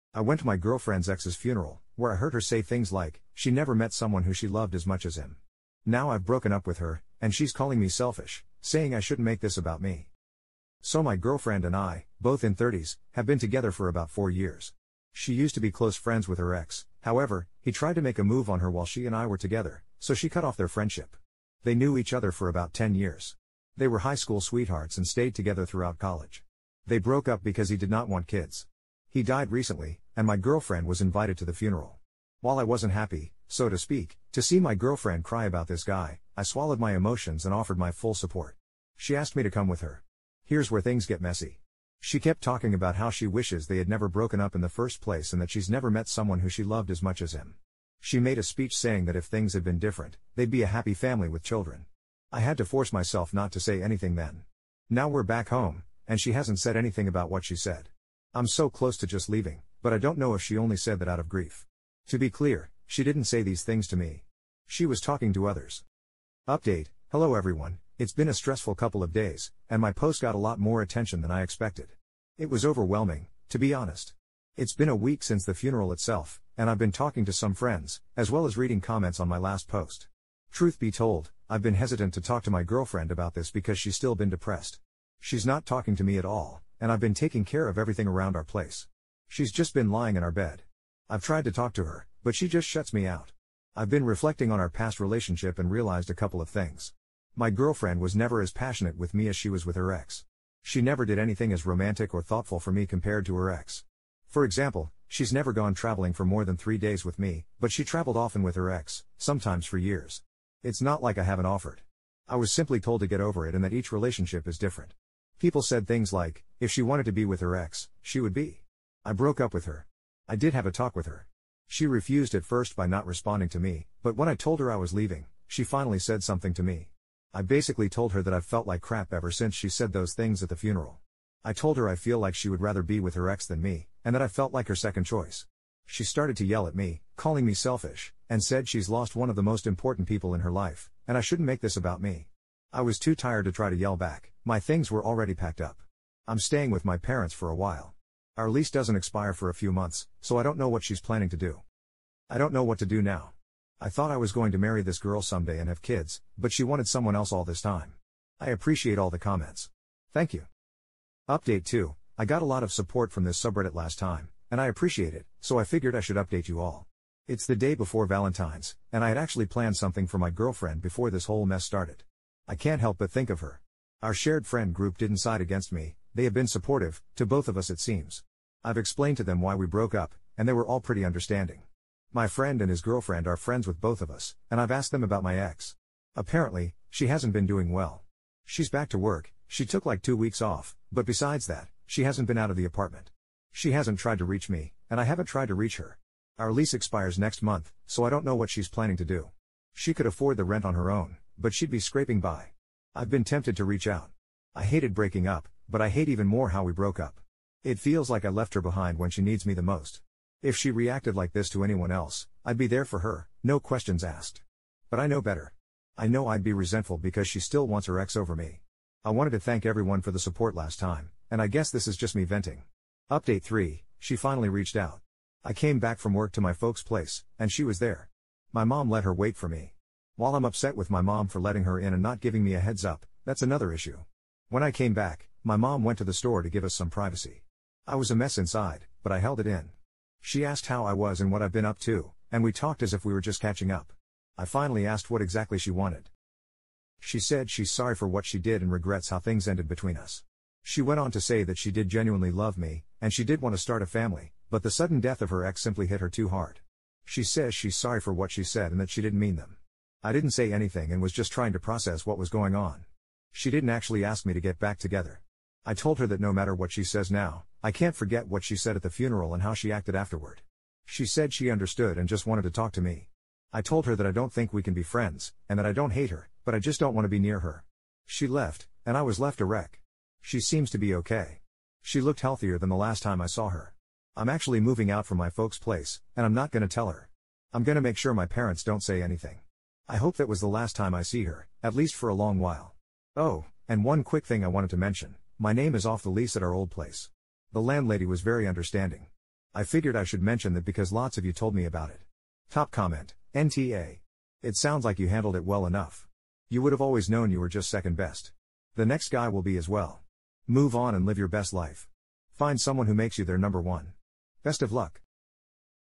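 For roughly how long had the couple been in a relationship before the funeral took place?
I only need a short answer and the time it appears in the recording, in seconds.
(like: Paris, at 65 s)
4 years, at 13 s.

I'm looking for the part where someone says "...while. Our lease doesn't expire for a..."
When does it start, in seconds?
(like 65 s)
147 s.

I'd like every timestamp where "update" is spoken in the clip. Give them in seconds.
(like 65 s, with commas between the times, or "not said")
66 s, 161 s, 166 s, 223 s.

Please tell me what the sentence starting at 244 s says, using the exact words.
I finally asked what exactly she wanted.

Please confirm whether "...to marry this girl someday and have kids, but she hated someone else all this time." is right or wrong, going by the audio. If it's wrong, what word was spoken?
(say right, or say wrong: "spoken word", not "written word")
wrong: "wanted", not "hated".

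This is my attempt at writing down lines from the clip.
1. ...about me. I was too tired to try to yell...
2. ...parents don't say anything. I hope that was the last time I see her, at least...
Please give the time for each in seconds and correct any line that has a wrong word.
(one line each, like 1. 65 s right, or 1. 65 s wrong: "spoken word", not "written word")
1. 141 s right
2. 288 s right.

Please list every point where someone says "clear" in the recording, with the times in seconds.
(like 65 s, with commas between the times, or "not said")
62 s.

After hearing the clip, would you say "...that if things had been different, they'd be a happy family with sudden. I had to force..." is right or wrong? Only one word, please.
wrong.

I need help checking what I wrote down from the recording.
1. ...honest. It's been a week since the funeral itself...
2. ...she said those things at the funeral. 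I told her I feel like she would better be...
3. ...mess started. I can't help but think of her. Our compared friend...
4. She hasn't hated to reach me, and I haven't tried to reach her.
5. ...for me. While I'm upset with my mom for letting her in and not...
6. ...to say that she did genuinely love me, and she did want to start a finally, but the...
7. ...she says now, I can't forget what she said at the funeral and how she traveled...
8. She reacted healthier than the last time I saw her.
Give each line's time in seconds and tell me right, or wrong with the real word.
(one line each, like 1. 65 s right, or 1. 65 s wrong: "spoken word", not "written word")
1. 73 s right
2. 129 s wrong: "rather", not "better"
3. 171 s wrong: "shared", not "compared"
4. 193 s wrong: "tried", not "hated"
5. 229 s right
6. 251 s wrong: "family", not "finally"
7. 266 s wrong: "acted", not "traveled"
8. 281 s wrong: "looked", not "reacted".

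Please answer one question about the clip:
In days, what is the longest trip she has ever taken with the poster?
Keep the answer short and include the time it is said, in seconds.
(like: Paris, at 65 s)
3 days, at 106 s.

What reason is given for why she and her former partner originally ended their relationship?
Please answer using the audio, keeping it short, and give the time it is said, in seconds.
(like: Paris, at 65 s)
He did not want kids, at 27 s.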